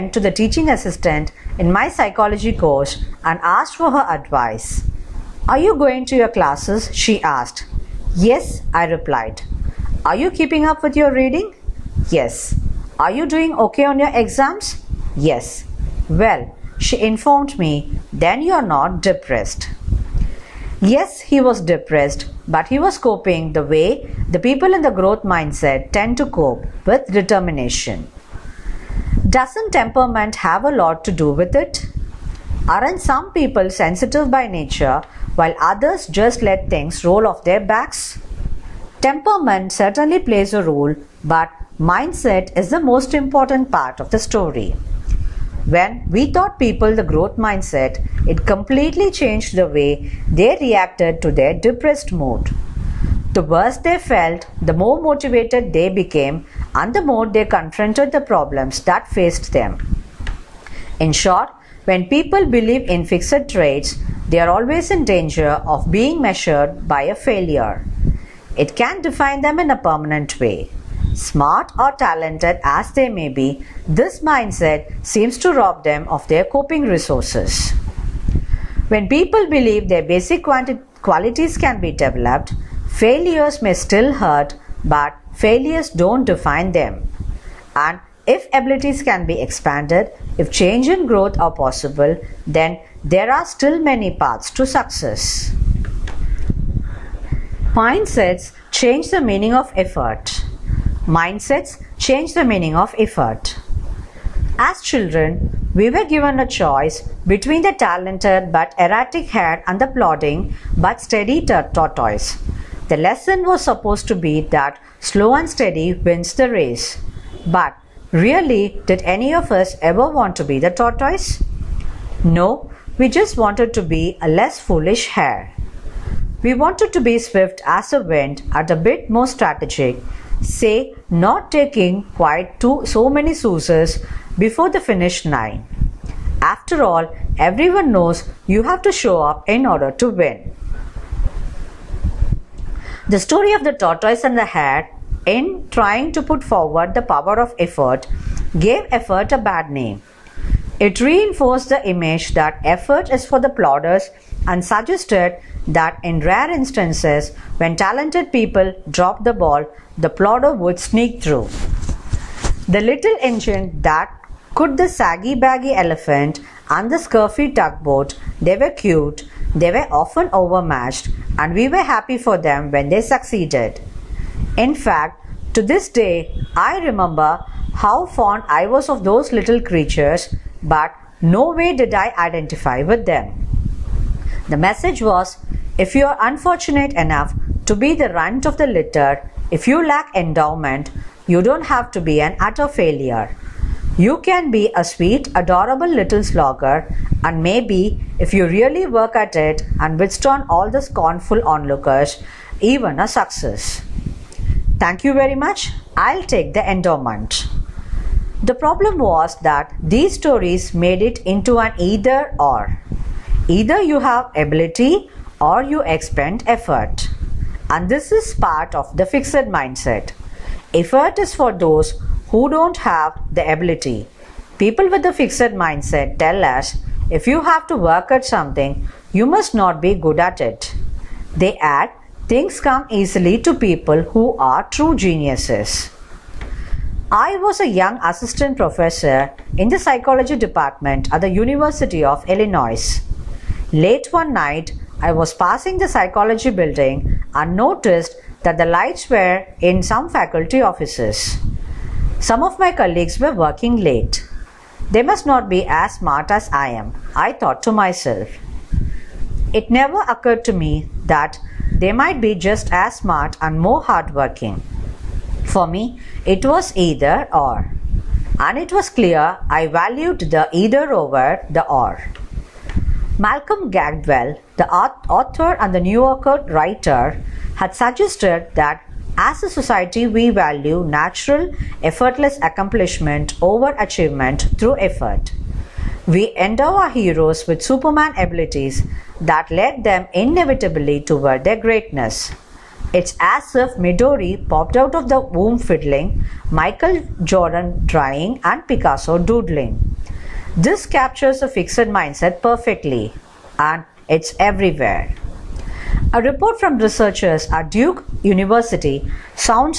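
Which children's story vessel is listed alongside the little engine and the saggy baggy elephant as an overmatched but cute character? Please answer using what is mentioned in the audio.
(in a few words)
Scuffy tugboat.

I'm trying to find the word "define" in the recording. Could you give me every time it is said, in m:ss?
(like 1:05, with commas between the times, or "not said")
1:09, 1:26.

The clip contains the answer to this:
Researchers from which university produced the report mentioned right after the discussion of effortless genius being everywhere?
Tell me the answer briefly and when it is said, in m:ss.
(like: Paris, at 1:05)
Duke University, at 5:07.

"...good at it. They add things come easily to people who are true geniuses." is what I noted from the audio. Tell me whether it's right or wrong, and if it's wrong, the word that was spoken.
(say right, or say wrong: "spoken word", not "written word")
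right.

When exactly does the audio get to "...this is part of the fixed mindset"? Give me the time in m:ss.
3:37.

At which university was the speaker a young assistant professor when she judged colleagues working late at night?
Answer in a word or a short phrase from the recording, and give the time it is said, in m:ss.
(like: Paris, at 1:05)
University of Illinois, at 4:01.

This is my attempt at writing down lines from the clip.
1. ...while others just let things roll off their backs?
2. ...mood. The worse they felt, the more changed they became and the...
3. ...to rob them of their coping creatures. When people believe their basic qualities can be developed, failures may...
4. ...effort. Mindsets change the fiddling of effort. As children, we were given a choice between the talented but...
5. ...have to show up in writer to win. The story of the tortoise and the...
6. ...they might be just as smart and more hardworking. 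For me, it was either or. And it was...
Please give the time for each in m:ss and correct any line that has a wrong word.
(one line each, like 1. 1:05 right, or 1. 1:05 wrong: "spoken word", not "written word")
1. 0:35 right
2. 0:52 wrong: "motivated", not "changed"
3. 1:15 wrong: "resources", not "creatures"
4. 1:39 wrong: "meaning", not "fiddling"
5. 2:18 wrong: "order", not "writer"
6. 4:21 right.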